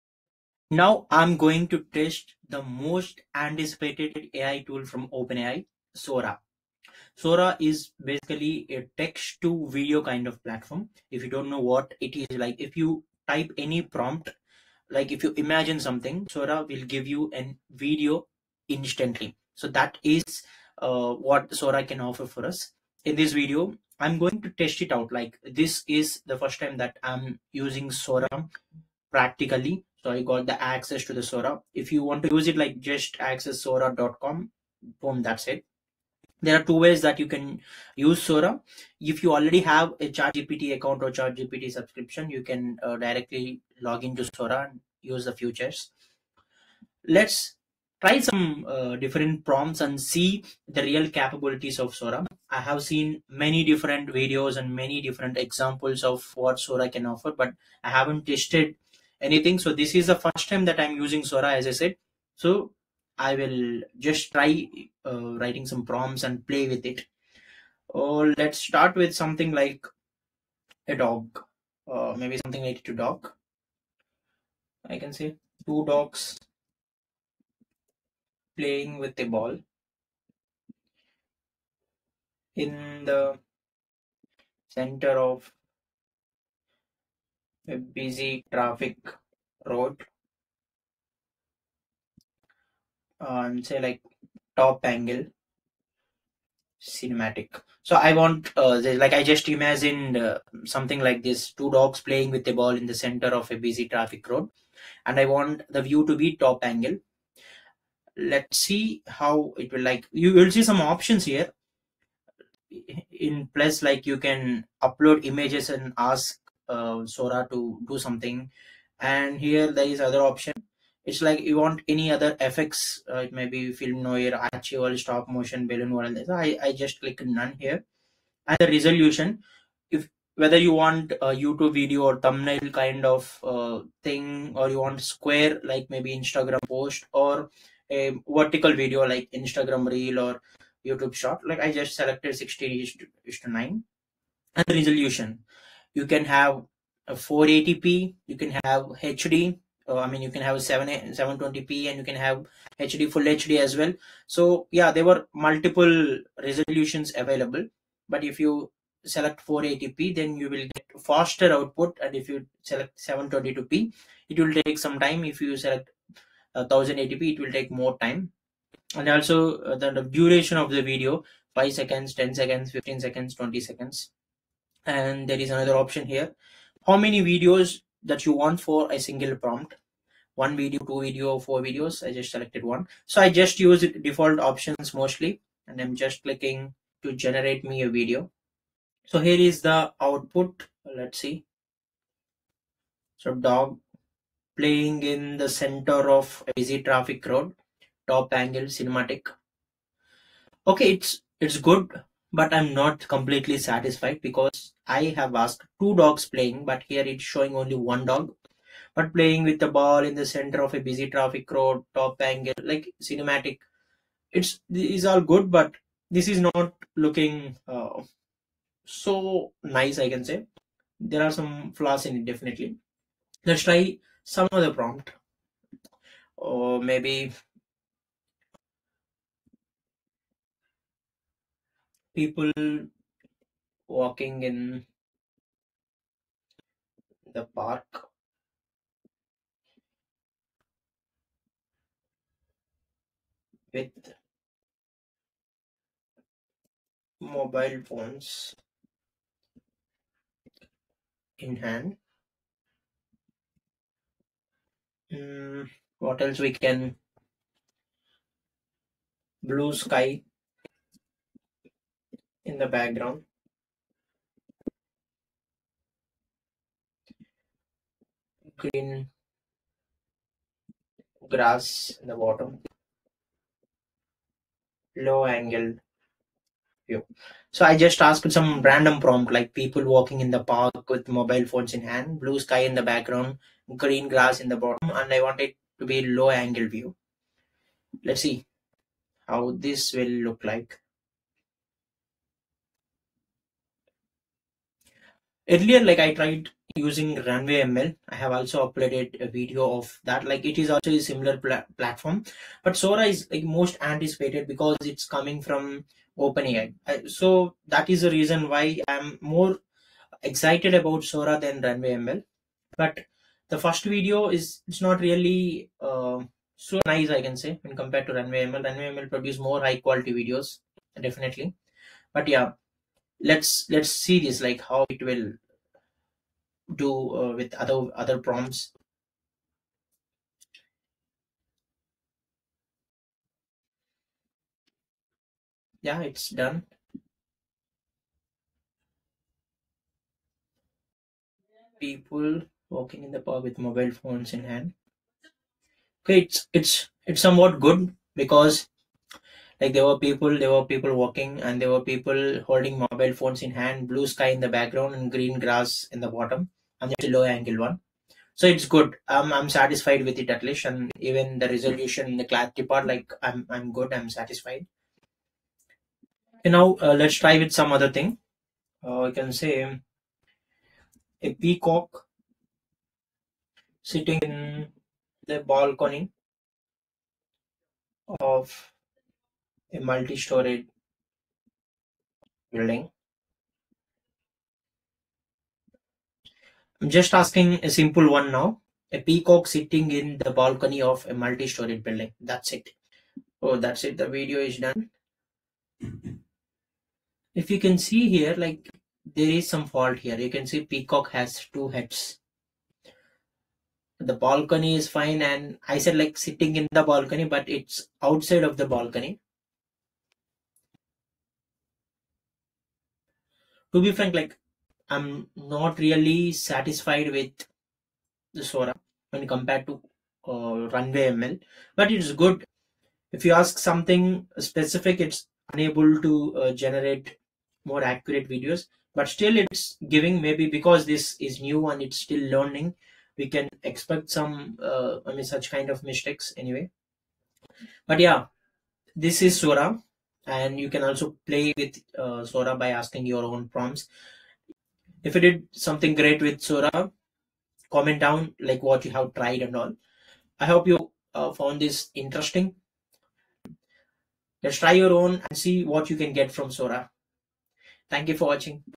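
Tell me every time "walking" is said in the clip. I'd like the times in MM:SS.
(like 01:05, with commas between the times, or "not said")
03:53, 04:39, 05:42, 05:50.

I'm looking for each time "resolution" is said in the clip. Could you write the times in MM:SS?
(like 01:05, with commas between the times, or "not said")
02:08, 02:24, 02:36, 06:01.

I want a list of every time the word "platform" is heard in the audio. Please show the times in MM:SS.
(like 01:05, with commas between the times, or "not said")
00:10, 05:01.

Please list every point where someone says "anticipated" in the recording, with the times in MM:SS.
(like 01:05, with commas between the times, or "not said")
00:03, 05:03.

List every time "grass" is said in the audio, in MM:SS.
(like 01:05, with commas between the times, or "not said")
04:31, 04:44, 05:55.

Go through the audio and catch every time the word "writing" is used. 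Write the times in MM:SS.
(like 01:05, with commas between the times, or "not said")
01:05.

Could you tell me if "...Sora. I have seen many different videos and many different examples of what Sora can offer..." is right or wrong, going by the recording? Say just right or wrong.
right.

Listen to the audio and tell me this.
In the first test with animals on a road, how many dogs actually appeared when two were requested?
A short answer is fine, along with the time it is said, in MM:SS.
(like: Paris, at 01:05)
1, at 03:27.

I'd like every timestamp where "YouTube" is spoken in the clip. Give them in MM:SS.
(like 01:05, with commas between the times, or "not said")
02:11, 02:20.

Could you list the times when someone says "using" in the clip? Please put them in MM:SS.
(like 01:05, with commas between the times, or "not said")
00:27, 01:00, 04:56.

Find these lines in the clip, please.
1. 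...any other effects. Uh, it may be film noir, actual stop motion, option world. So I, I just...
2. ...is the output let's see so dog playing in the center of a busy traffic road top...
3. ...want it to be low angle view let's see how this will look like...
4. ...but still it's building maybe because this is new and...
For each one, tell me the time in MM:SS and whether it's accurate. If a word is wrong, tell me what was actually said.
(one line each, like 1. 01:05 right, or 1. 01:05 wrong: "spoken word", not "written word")
1. 02:01 wrong: "balloon", not "option"
2. 03:09 right
3. 04:45 right
4. 07:08 wrong: "giving", not "building".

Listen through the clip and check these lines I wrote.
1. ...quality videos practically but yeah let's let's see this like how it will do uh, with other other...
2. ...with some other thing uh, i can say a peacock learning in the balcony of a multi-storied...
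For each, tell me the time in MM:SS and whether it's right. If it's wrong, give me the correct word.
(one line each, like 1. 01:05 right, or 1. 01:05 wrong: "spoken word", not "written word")
1. 05:19 wrong: "definitely", not "practically"
2. 06:07 wrong: "sitting", not "learning".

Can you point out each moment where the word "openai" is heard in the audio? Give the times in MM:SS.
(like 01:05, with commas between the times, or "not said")
00:05, 05:06.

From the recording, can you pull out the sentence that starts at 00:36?
There are two ways that you can use Sora.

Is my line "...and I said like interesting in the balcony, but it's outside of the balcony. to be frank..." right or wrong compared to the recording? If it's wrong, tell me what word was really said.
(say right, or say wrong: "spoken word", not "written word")
wrong: "sitting", not "interesting".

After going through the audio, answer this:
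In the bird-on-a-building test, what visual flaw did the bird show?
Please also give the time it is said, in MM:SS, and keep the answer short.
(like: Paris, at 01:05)
two heads, at 06:41.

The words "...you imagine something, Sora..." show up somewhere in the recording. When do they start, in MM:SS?
00:15.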